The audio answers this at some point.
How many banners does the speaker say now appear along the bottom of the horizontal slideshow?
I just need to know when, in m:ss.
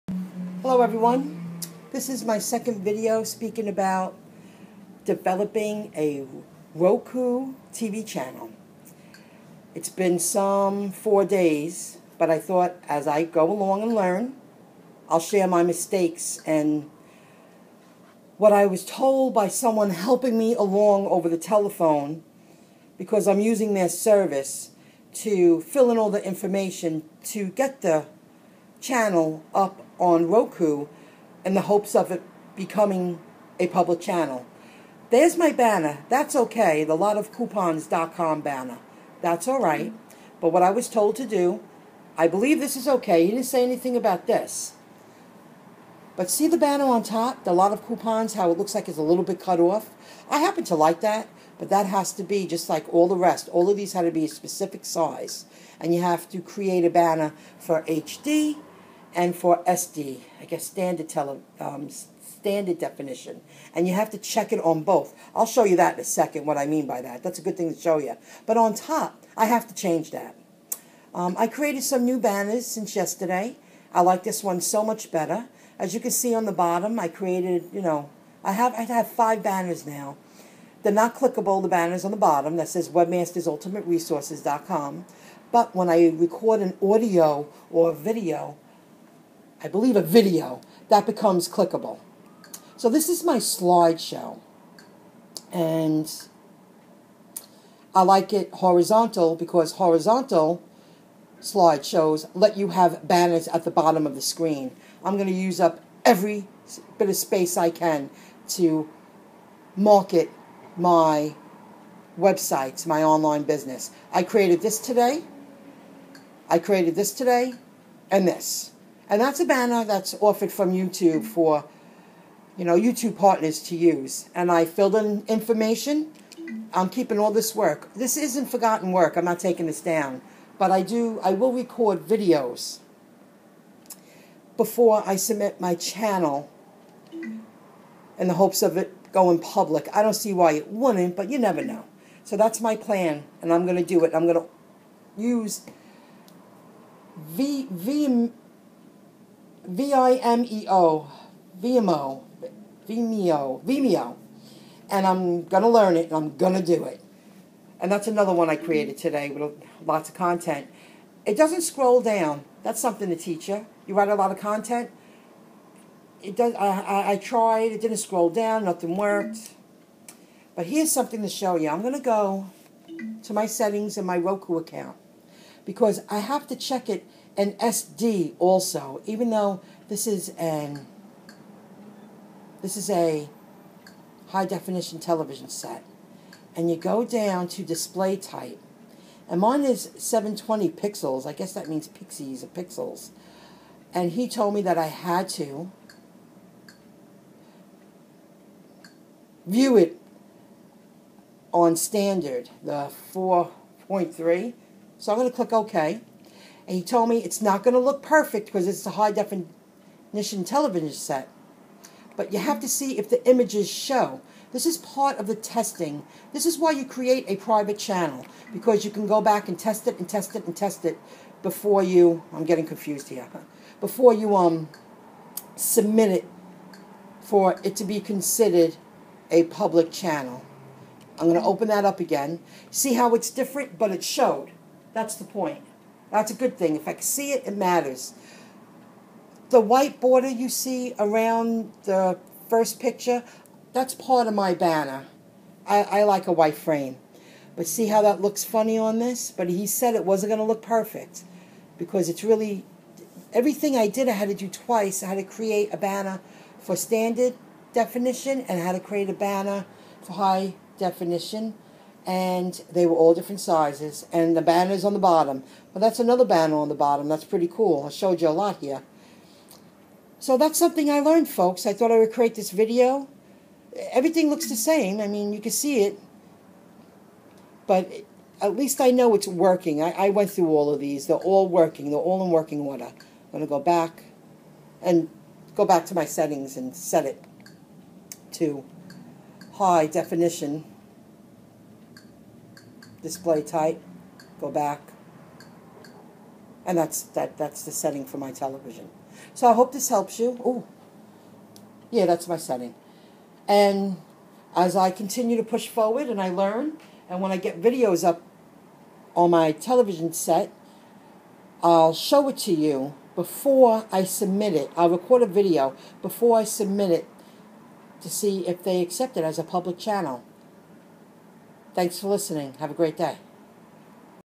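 1:19.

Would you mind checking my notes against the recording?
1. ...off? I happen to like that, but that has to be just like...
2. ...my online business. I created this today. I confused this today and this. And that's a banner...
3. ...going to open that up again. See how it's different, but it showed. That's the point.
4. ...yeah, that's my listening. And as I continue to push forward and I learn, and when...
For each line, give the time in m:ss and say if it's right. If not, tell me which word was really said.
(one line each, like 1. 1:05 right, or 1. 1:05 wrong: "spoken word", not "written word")
1. 0:49 right
2. 1:52 wrong: "created", not "confused"
3. 3:51 right
4. 5:01 wrong: "setting", not "listening".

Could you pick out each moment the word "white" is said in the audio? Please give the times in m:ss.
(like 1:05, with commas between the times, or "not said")
3:59, 4:06.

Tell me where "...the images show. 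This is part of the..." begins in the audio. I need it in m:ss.
3:33.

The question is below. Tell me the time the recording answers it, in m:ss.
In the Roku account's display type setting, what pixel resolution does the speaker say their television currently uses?
3:09.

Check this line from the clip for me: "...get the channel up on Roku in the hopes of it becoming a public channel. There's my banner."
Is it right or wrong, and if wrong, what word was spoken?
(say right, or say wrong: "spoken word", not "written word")
right.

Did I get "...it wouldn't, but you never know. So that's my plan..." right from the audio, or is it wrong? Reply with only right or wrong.
right.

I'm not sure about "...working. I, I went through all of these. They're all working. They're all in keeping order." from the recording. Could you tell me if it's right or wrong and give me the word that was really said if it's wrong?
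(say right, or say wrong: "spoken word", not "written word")
wrong: "working", not "keeping".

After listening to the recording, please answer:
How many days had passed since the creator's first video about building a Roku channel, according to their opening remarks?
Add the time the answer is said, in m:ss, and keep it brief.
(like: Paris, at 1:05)
4, at 0:10.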